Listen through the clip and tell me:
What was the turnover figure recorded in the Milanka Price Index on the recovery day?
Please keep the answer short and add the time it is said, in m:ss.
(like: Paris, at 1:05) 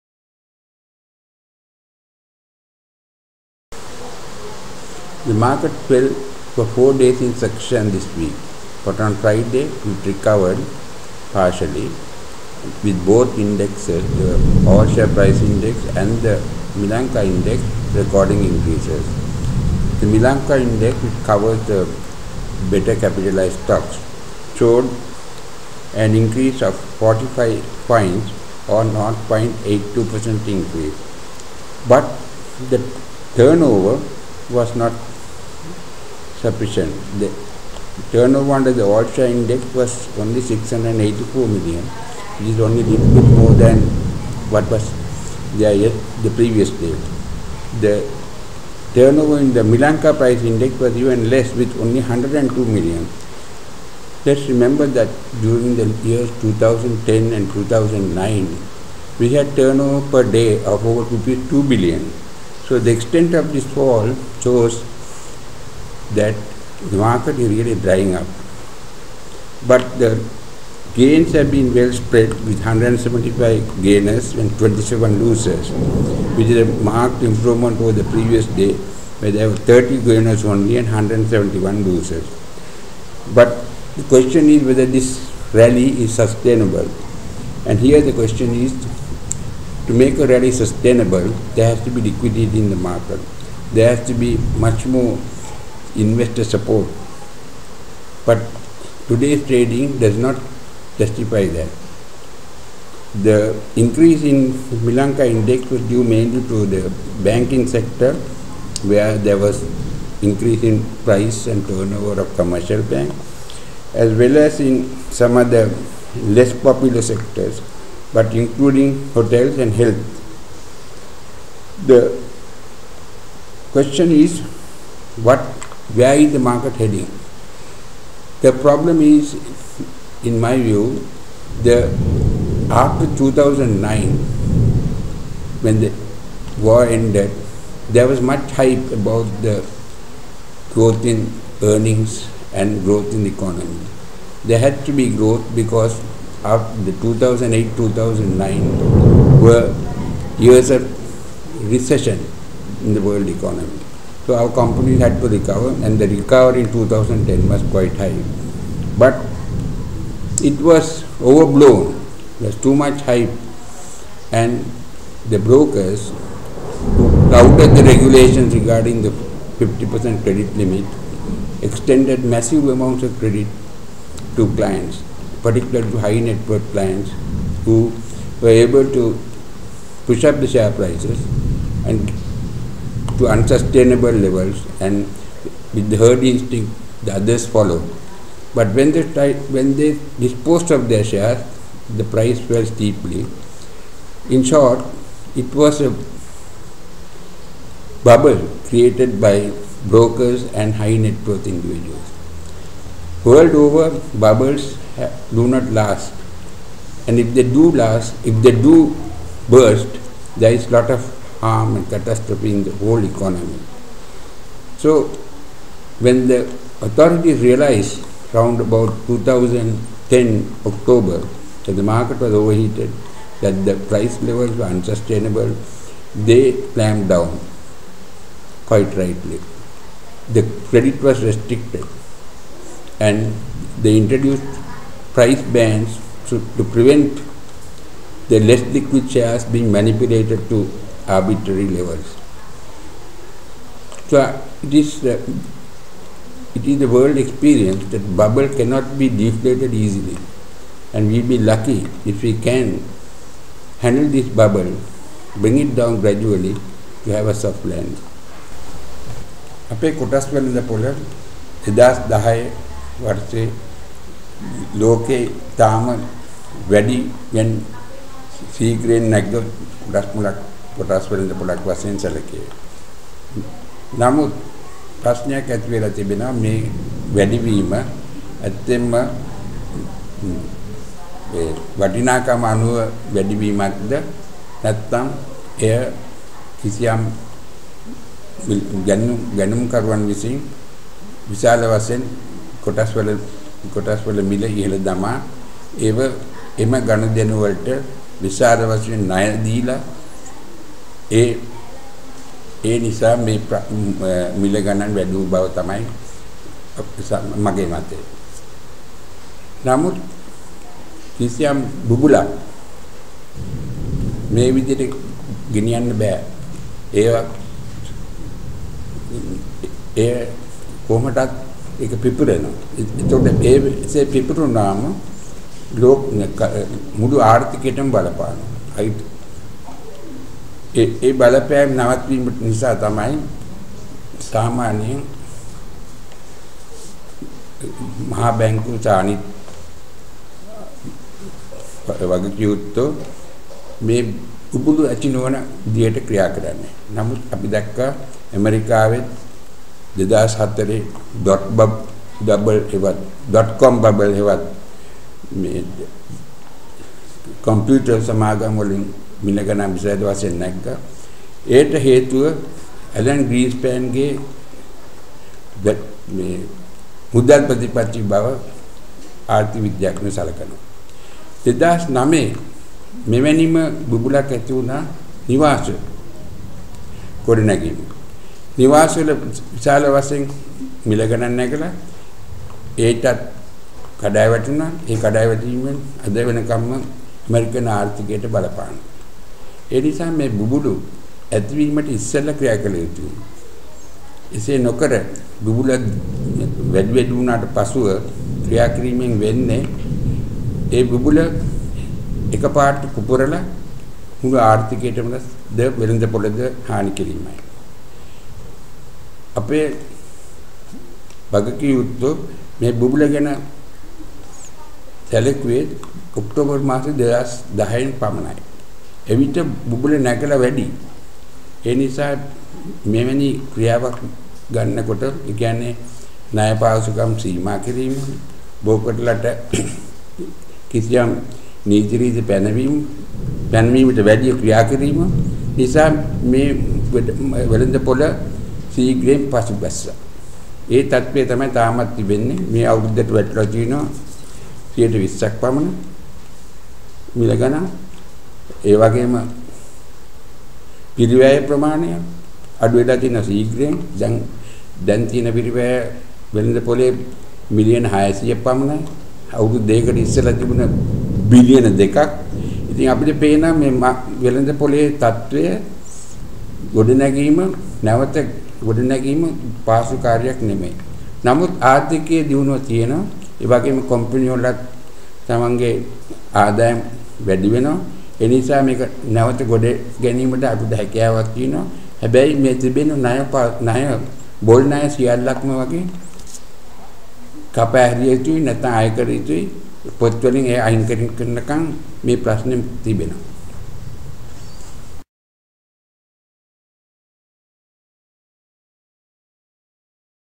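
102 million, at 0:52.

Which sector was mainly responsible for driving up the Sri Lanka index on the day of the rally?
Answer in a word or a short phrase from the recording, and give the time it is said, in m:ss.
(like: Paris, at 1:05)
banking sector, at 1:47.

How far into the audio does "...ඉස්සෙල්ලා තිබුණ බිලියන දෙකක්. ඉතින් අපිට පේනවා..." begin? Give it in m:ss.
7:40.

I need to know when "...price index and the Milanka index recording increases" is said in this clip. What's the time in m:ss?
0:15.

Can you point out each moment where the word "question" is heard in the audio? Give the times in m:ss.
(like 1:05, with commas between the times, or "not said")
1:24, 1:28, 2:03.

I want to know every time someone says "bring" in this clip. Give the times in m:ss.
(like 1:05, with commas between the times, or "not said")
4:15.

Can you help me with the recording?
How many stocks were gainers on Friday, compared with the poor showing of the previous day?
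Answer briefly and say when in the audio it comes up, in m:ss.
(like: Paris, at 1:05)
175, at 1:12.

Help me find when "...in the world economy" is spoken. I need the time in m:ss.
2:32.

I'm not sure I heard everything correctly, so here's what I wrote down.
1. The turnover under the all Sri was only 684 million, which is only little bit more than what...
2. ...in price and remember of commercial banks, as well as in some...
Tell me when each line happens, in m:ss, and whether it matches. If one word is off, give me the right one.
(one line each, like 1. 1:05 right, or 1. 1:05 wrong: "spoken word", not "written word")
1. 0:37 wrong: "Index", not "Sri"
2. 1:50 wrong: "turnover", not "remember".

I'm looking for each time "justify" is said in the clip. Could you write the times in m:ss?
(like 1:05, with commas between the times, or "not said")
1:40.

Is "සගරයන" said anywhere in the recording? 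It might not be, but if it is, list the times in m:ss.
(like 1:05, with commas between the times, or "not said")
7:18, 7:33.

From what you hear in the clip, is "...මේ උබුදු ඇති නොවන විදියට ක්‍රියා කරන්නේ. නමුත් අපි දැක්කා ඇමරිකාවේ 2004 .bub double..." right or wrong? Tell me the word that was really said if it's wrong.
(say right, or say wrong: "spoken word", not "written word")
right.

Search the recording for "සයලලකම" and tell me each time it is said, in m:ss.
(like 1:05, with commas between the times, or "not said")
8:04.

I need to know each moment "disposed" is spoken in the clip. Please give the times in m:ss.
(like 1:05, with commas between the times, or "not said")
3:10.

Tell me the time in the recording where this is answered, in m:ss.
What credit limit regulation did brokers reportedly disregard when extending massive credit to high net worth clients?
2:49.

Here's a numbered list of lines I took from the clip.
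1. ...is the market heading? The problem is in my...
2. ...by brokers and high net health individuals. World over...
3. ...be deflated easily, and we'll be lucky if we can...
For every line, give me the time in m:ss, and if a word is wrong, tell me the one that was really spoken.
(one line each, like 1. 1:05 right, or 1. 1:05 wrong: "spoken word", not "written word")
1. 2:06 right
2. 3:19 wrong: "worth", not "health"
3. 4:08 right.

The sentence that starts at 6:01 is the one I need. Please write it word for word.
ඒට හේතුව ඇලන් ග්‍රීස්පෑන්ගේ මේ මුදල් ප්‍රතිපත්ති බව ආර්ථික විද්‍යාඥයෝ සලකනවා.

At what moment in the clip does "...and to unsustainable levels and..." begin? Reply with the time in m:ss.
3:01.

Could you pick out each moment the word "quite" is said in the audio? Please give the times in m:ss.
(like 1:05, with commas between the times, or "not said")
2:37, 3:48.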